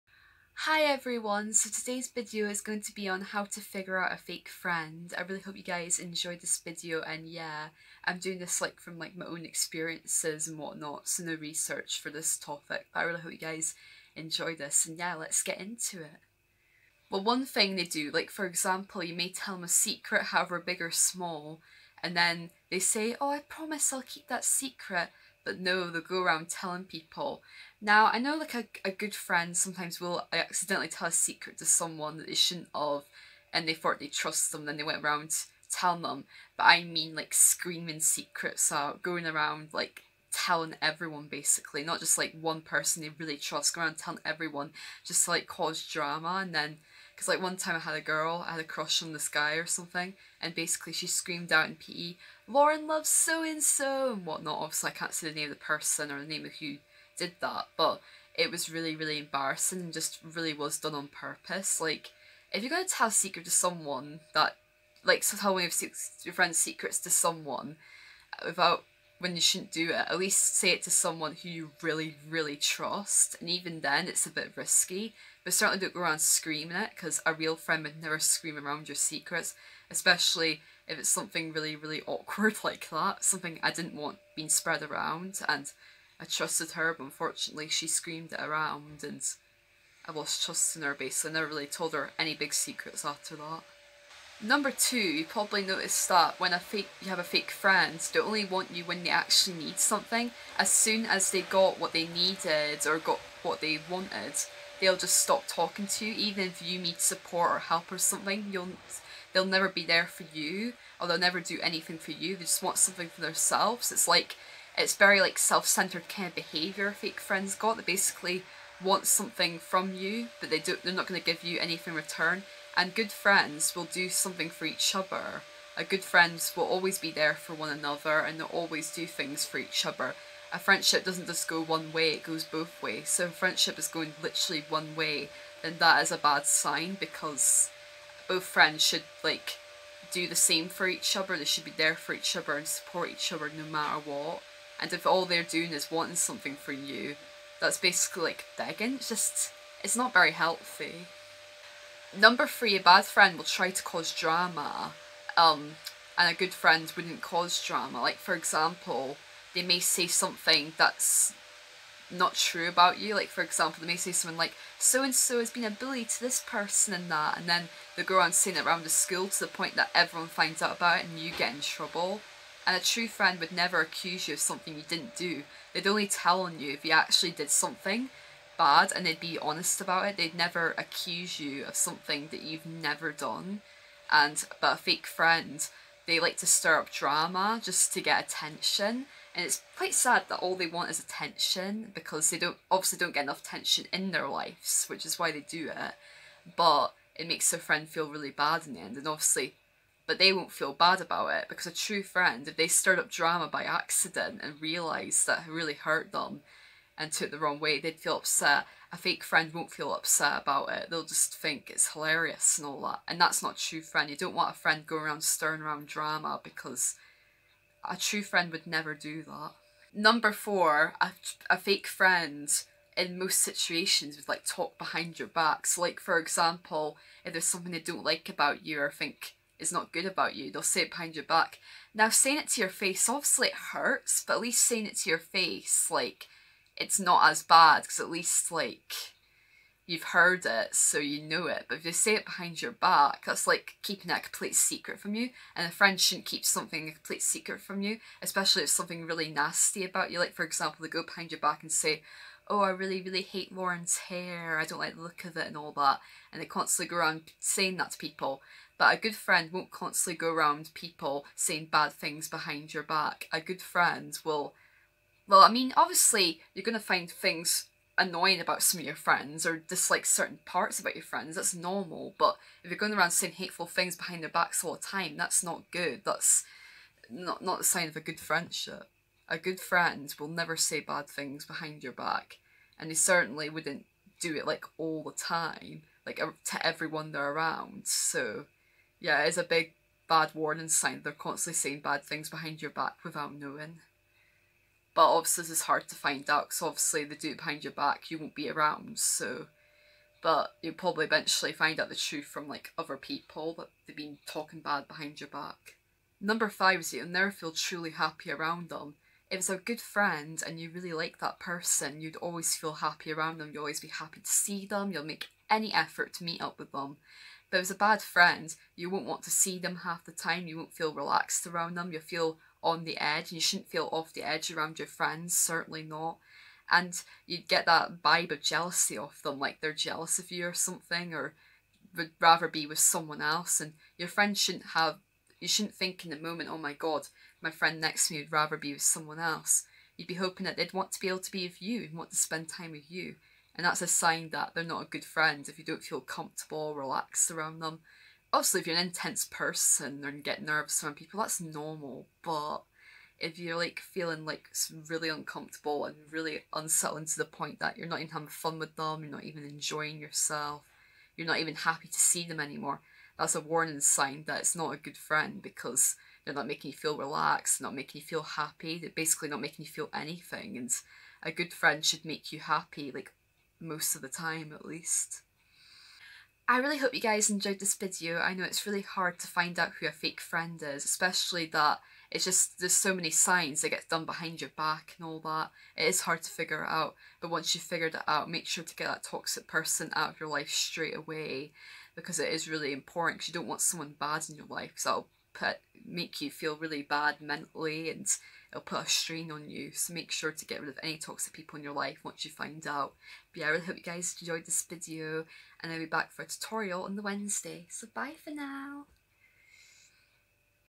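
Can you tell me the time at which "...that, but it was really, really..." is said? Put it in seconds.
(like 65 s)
57 s.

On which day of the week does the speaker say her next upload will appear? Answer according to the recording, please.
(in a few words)
Wednesday.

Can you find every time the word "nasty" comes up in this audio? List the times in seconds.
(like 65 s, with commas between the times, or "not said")
249 s.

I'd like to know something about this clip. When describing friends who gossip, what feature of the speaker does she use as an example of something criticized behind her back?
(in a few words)
Hair.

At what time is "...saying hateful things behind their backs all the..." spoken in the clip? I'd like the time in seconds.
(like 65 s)
273 s.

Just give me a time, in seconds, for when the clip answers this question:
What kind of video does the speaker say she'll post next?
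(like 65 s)
406 s.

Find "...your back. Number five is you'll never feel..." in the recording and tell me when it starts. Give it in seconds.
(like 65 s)
305 s.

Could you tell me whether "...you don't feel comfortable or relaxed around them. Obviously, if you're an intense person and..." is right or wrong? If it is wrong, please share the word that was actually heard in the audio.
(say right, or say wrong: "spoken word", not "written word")
right.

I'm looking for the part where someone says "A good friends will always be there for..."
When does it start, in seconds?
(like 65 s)
125 s.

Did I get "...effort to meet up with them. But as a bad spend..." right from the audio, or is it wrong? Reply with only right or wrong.
wrong.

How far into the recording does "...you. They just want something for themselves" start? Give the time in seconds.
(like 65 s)
112 s.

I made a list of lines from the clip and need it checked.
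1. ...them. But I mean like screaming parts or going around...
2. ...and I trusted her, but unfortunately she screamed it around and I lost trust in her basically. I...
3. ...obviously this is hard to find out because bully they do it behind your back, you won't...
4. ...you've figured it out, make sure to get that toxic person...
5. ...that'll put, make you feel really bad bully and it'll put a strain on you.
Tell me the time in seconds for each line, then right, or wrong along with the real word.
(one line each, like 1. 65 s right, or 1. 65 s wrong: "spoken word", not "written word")
1. 36 s wrong: "secrets", not "parts"
2. 85 s right
3. 295 s wrong: "obviously", not "bully"
4. 387 s right
5. 394 s wrong: "mentally", not "bully".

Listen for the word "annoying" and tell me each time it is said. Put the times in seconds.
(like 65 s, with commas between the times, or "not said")
267 s.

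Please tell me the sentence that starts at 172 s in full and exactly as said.
And a true friend would never accuse you of something you didn't do.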